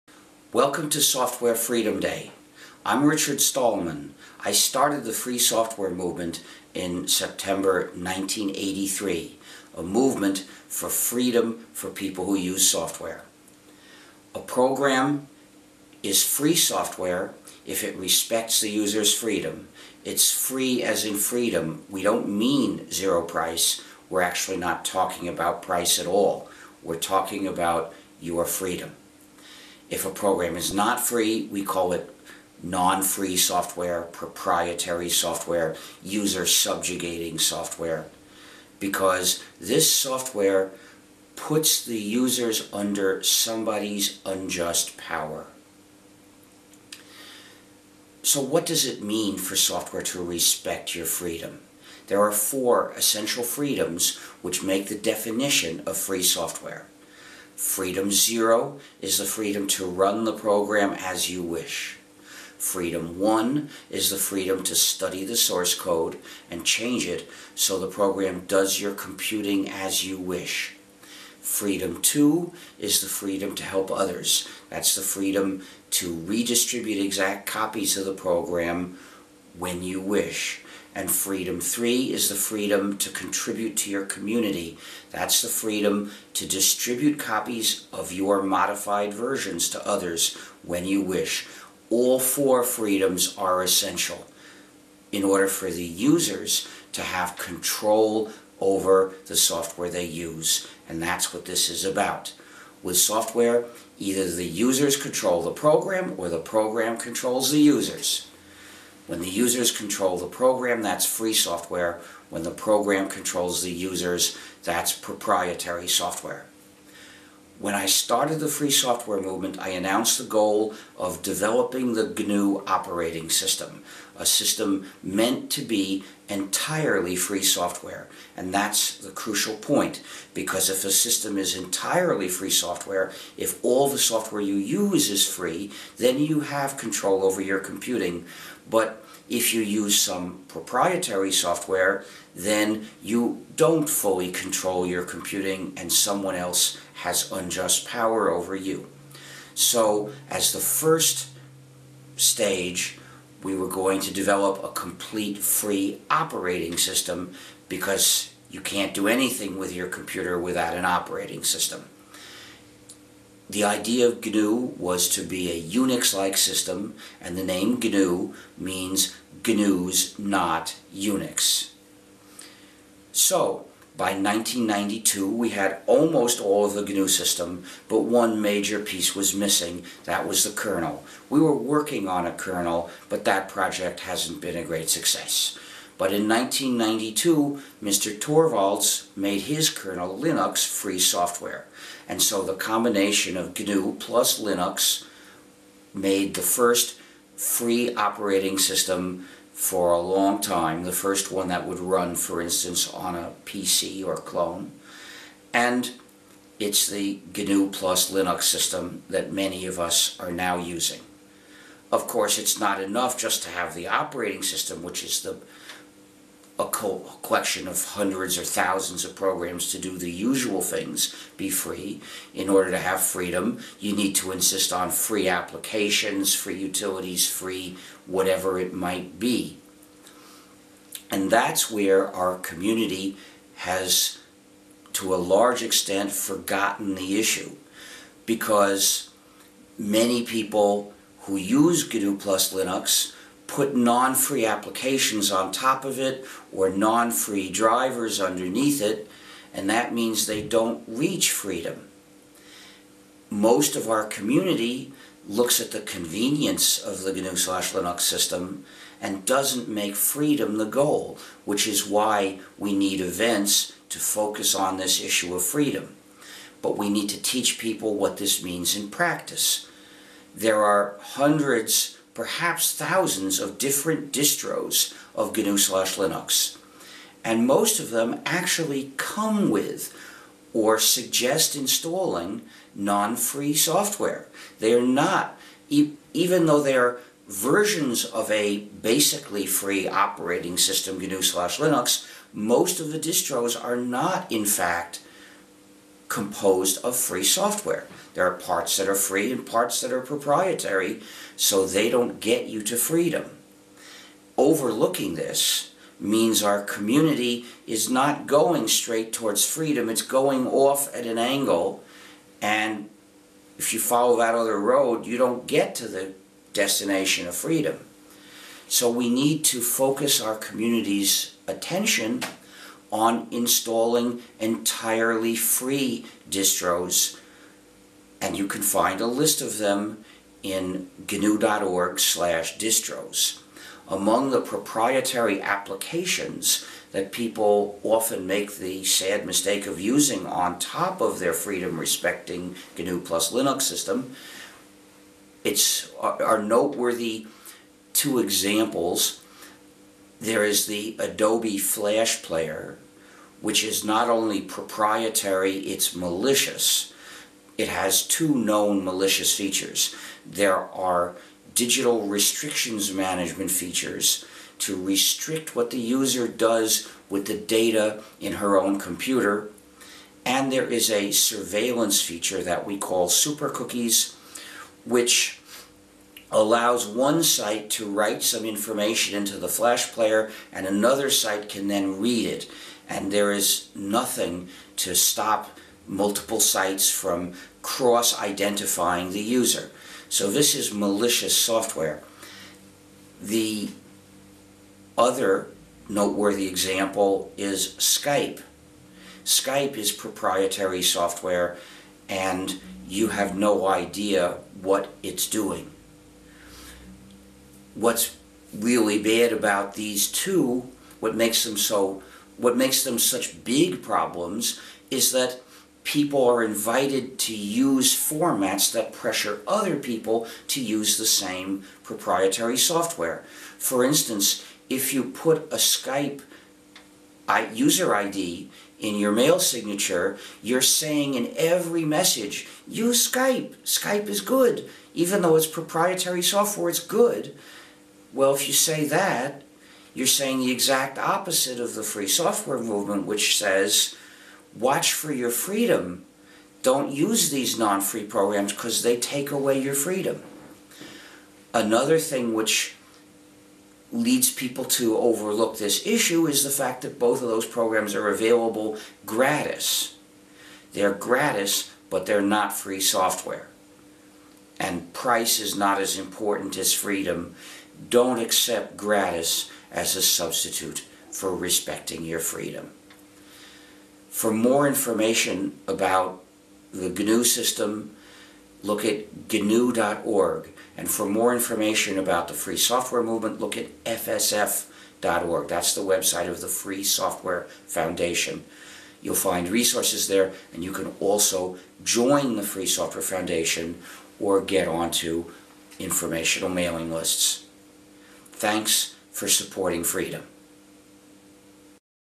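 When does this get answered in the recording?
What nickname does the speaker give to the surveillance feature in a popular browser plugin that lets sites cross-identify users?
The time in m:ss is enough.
6:13.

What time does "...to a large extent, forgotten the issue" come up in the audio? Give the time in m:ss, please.
3:54.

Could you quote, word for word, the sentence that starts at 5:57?
It has two known malicious features.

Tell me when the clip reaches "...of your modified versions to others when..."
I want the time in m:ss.
1:27.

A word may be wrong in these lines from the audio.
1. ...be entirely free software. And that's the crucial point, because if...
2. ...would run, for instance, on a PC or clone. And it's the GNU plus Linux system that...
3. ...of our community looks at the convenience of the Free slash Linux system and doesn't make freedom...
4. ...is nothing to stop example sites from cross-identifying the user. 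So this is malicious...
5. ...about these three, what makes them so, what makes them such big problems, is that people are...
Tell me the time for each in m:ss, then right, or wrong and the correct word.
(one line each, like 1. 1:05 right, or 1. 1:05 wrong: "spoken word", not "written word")
1. 2:05 right
2. 3:21 right
3. 4:13 wrong: "GNU", not "Free"
4. 6:23 wrong: "multiple", not "example"
5. 6:49 wrong: "two", not "three".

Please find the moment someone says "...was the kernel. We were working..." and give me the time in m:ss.
3:00.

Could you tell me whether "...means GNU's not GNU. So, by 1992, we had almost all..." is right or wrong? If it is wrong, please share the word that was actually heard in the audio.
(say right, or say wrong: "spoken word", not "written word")
wrong: "Unix", not "GNU".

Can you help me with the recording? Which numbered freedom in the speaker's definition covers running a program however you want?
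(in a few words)
Freedom zero.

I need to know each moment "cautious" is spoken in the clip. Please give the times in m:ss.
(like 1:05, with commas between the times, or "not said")
not said.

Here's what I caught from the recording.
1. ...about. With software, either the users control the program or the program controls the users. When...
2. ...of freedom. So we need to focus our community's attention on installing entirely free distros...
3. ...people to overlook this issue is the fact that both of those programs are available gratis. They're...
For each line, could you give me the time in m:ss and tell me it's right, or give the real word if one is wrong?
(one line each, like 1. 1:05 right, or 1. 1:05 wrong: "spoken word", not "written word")
1. 1:41 right
2. 5:17 right
3. 7:34 right.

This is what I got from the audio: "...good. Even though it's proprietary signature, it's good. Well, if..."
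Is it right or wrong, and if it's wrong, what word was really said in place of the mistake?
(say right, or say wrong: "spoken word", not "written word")
wrong: "software", not "signature".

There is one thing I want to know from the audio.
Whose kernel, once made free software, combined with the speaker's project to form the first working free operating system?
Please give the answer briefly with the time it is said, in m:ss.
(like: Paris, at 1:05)
Mr. Torvalds, at 3:07.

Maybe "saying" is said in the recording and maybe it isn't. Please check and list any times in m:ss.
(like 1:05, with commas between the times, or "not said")
7:10, 7:20.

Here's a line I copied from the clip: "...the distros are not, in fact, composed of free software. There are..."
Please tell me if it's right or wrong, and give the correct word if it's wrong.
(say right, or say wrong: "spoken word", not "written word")
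right.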